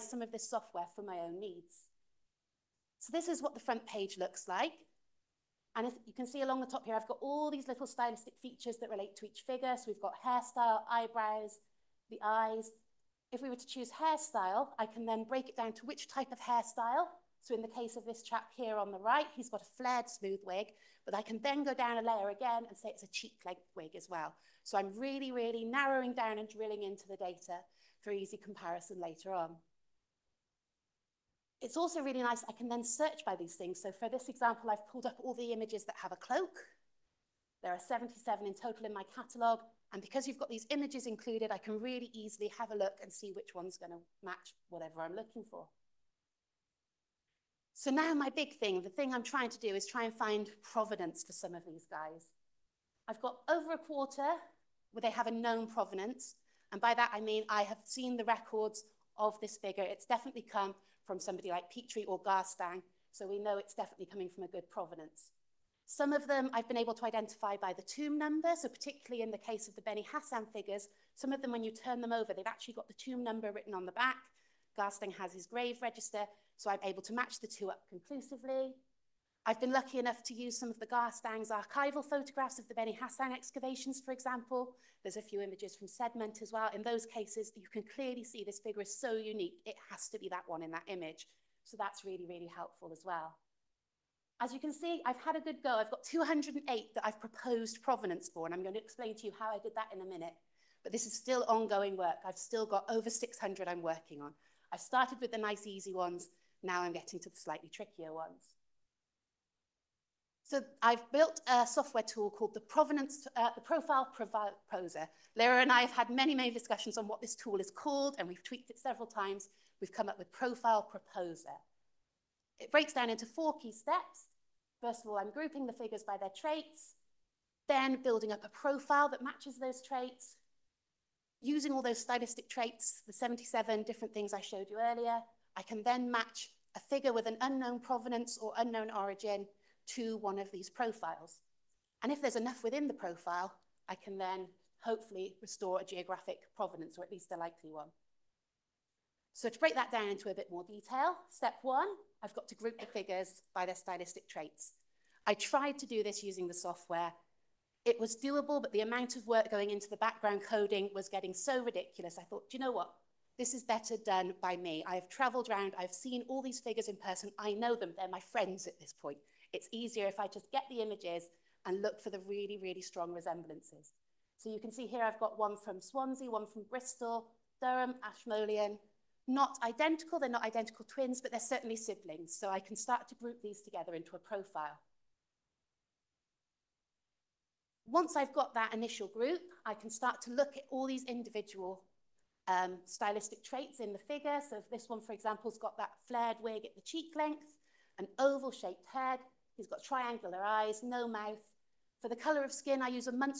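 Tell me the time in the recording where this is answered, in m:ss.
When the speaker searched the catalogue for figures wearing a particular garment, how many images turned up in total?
0:37.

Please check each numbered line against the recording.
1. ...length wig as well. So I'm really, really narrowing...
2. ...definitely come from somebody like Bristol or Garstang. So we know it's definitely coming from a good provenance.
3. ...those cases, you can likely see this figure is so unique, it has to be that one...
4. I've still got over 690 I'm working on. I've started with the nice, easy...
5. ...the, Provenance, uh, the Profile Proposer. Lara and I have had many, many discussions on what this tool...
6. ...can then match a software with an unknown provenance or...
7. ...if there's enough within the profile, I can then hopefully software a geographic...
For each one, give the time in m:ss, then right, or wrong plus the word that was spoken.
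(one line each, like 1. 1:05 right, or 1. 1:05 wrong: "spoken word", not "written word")
1. 0:23 right
2. 1:00 wrong: "Petrie", not "Bristol"
3. 1:26 wrong: "clearly", not "likely"
4. 1:42 wrong: "600", not "690"
5. 1:52 right
6. 2:15 wrong: "figure", not "software"
7. 2:22 wrong: "restore", not "software".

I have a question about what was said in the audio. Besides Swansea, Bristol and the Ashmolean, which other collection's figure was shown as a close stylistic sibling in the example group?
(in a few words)
Durham.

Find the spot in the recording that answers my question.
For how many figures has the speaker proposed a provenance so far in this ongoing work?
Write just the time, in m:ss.
1:35.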